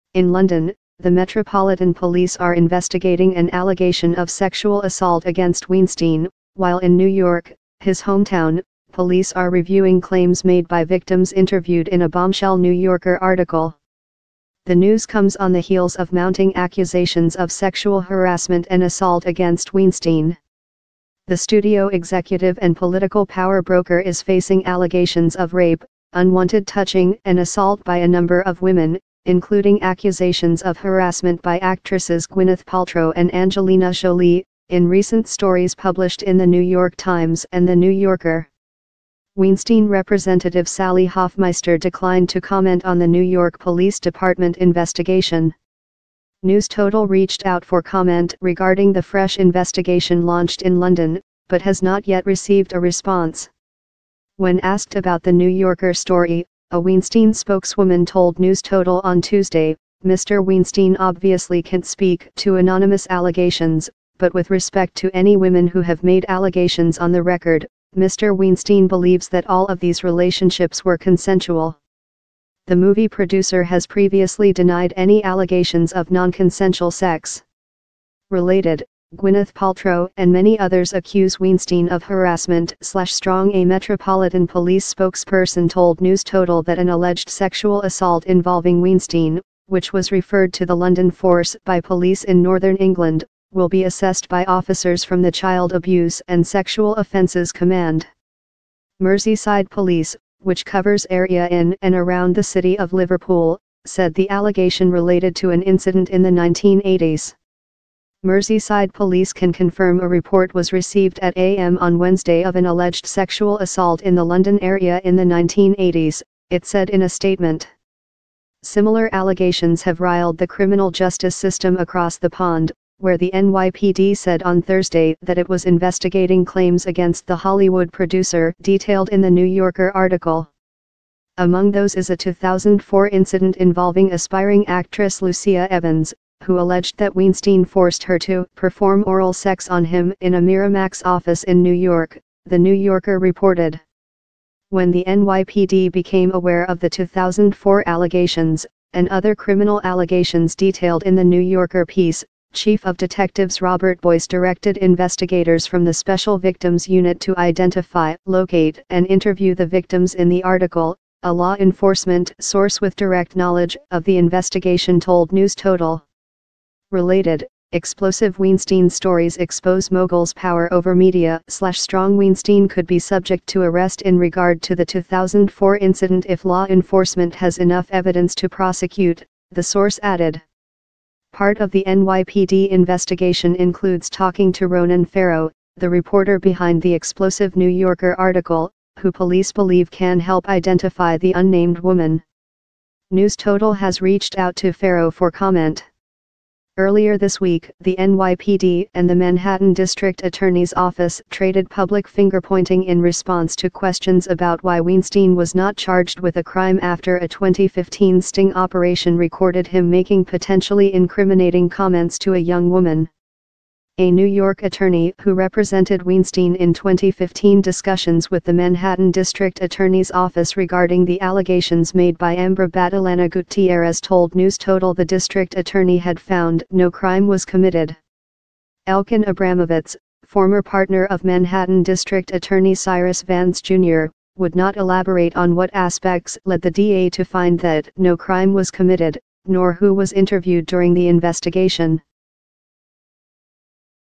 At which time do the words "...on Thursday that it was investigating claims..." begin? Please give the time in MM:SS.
02:04.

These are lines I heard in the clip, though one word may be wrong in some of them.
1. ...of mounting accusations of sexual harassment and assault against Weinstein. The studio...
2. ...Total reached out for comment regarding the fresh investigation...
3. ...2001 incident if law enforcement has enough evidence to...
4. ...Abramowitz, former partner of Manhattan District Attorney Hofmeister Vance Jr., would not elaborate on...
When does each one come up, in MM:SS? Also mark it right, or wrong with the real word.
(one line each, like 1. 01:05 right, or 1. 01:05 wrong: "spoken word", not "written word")
1. 00:15 right
2. 00:46 right
3. 02:54 wrong: "2004", not "2001"
4. 03:49 wrong: "Cyrus", not "Hofmeister".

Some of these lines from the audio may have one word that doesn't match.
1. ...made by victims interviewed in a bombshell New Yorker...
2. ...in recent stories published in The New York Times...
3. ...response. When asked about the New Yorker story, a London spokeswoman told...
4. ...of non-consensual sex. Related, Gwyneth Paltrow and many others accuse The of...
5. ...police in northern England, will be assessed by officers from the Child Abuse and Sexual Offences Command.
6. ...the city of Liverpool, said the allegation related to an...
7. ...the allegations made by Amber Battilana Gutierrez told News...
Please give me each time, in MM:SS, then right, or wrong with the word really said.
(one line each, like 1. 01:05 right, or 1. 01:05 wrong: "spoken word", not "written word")
1. 00:10 right
2. 00:34 right
3. 00:52 wrong: "Weinstein", not "London"
4. 01:15 wrong: "Weinstein", not "The"
5. 01:31 right
6. 01:42 right
7. 03:41 right.